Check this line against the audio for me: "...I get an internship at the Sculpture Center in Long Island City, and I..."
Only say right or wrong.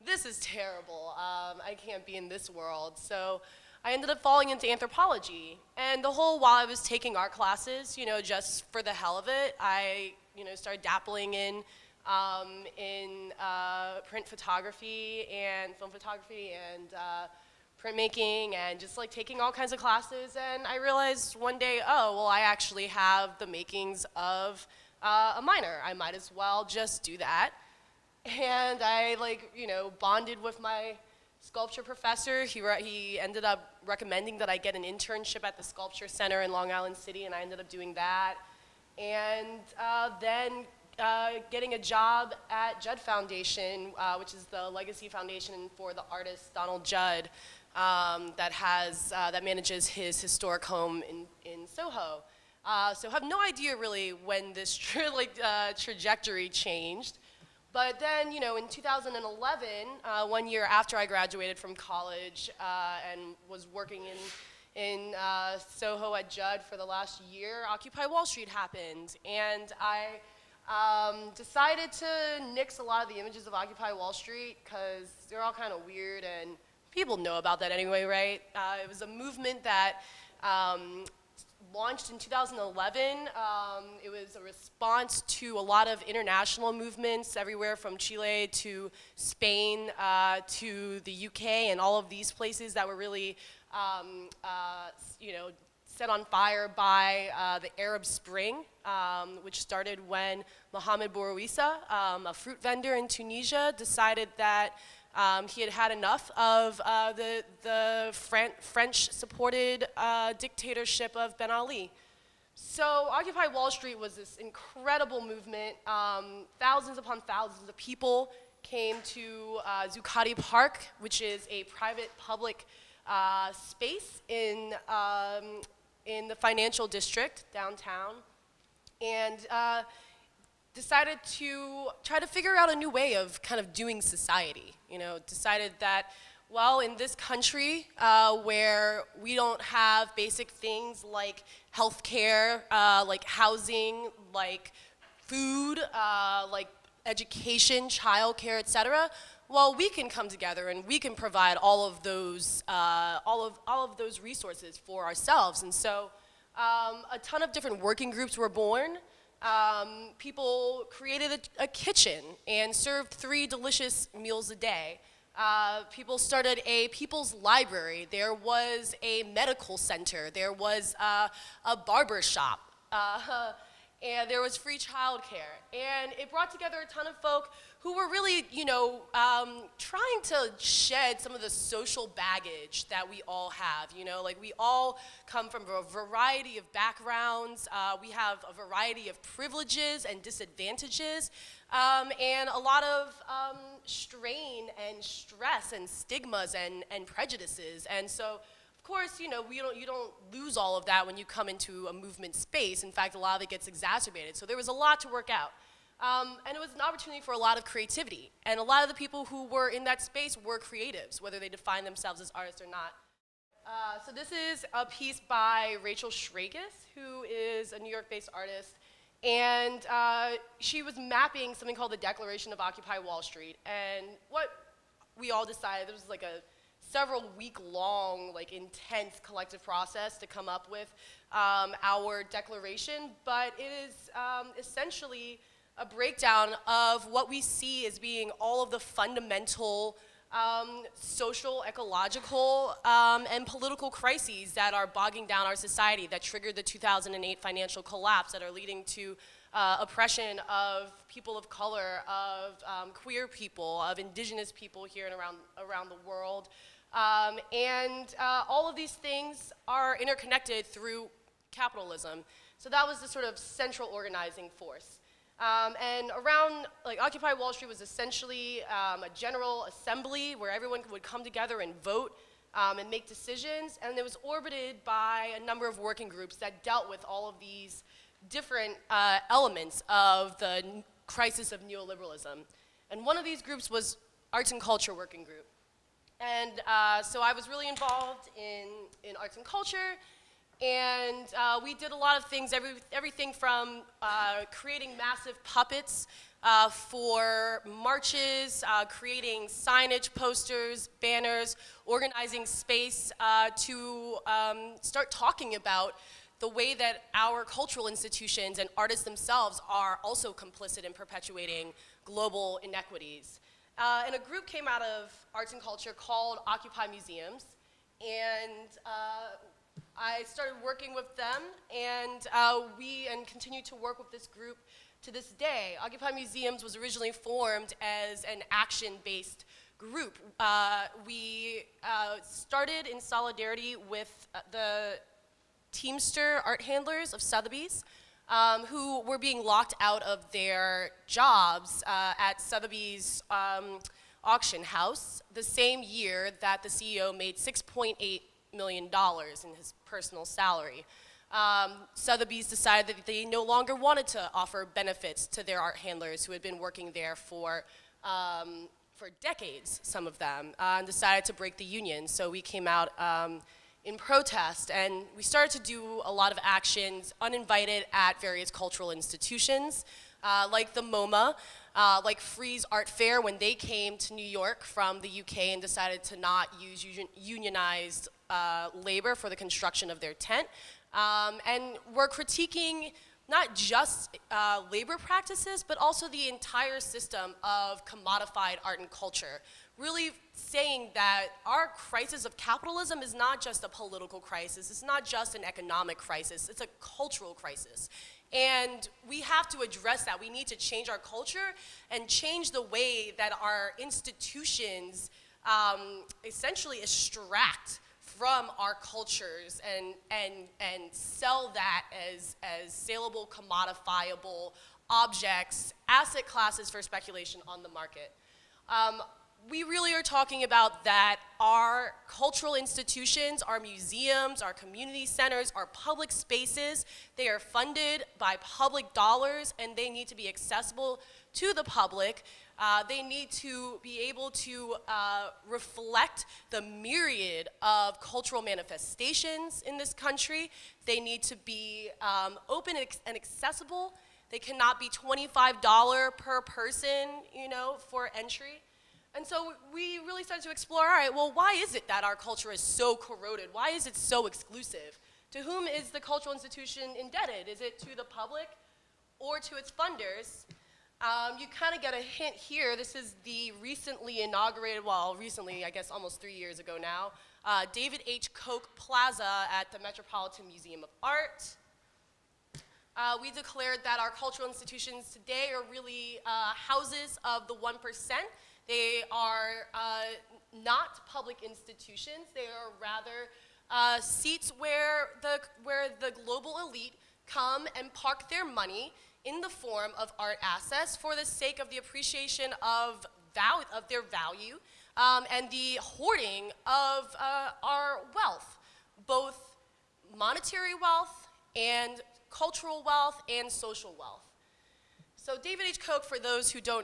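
right.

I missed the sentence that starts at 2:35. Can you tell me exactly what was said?
And so, um, a ton of different working groups were born.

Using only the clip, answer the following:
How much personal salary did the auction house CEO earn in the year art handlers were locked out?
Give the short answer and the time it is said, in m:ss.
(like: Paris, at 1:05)
6.8 million dollars, at 5:47.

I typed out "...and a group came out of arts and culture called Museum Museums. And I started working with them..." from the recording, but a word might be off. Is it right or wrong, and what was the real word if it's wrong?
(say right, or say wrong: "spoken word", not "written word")
wrong: "Occupy", not "Museum".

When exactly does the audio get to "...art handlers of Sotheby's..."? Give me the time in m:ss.
5:36.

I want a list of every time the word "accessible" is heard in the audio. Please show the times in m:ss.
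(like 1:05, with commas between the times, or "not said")
7:10, 7:23.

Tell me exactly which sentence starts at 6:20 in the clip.
Um, and we're critiquing not just uh, labor practices, but also the entire system of commodified art and culture.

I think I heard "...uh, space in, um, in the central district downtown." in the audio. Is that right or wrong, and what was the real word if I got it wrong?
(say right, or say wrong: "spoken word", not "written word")
wrong: "financial", not "central".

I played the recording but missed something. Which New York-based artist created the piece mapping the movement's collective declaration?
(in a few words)
Rachel Schragis.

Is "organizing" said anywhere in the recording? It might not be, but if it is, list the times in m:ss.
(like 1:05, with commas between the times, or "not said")
4:23, 5:01.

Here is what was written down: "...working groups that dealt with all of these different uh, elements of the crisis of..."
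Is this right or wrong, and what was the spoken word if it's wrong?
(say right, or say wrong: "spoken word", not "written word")
right.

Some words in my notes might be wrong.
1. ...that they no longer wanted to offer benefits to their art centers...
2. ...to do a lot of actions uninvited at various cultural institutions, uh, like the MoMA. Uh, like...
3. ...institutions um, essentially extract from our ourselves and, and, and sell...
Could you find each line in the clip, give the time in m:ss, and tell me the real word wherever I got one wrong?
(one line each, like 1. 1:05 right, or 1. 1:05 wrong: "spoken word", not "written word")
1. 5:52 wrong: "handlers", not "centers"
2. 6:05 right
3. 6:43 wrong: "cultures", not "ourselves".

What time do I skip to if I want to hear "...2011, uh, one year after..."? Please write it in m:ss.
0:58.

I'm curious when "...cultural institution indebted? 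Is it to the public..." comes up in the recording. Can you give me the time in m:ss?
7:35.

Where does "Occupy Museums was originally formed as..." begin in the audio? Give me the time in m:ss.
5:25.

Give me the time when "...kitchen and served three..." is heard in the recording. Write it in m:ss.
2:41.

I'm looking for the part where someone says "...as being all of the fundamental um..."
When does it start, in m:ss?
3:57.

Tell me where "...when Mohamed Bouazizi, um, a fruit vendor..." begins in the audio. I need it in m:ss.
1:40.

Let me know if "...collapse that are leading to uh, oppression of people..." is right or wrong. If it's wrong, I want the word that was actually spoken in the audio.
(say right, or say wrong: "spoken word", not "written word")
right.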